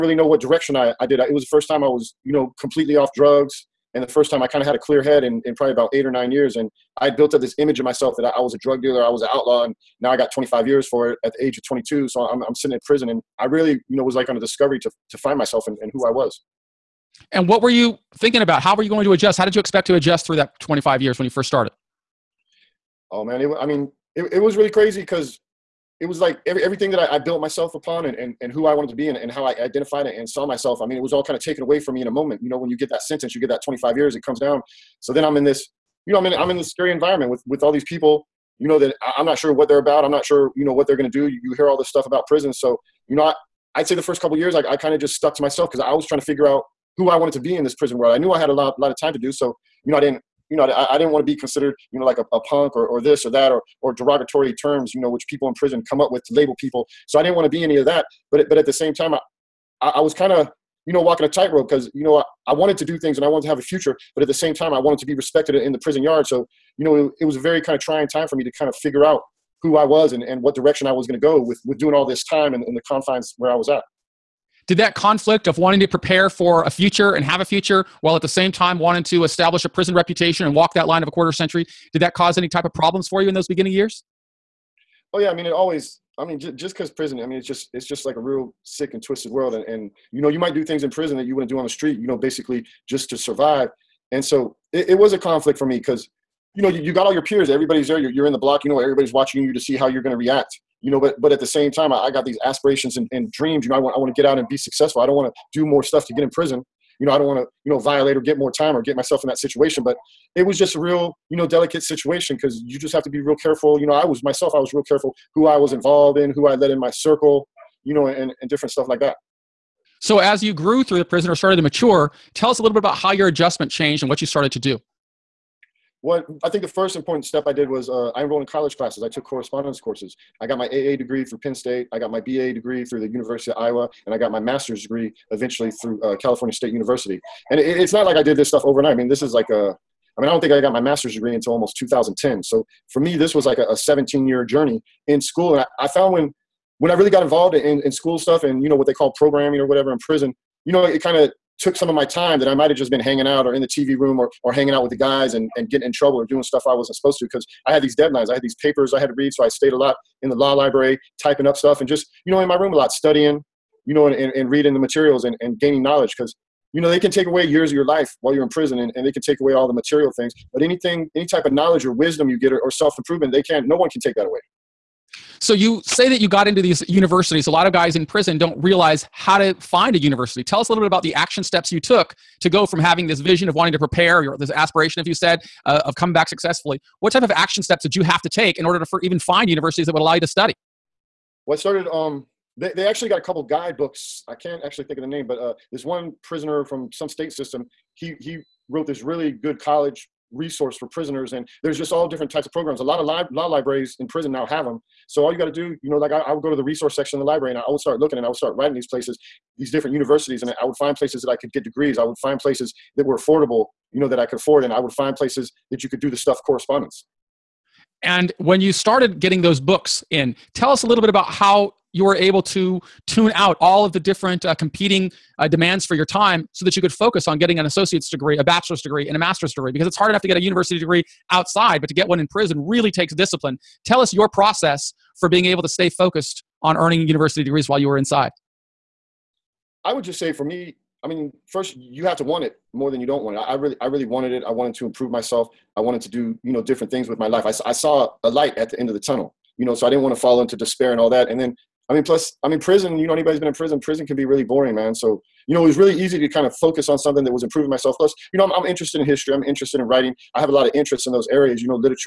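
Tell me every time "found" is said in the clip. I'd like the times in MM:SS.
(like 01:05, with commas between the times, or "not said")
02:25.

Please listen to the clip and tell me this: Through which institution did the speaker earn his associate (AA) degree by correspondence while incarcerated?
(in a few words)
Penn State.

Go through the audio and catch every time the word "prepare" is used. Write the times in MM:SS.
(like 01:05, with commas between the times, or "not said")
01:15, 03:03.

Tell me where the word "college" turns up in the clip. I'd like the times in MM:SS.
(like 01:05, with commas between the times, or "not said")
02:08, 03:19.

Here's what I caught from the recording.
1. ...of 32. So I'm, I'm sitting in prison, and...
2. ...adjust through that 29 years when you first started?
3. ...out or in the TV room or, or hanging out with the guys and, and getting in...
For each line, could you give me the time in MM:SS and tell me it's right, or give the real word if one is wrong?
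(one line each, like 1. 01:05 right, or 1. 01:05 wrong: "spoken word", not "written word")
1. 00:11 wrong: "22", not "32"
2. 00:19 wrong: "25", not "29"
3. 02:33 right.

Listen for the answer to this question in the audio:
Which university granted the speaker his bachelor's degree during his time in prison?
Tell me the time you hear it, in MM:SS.
02:13.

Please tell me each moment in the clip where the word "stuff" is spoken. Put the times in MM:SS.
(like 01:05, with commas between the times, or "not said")
00:41, 01:45, 01:58, 02:18, 02:28, 02:36, 02:41, 03:36.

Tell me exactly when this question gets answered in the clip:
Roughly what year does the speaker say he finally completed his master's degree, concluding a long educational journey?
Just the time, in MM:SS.
02:21.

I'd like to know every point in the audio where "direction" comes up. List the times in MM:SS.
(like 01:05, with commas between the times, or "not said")
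00:00, 01:10.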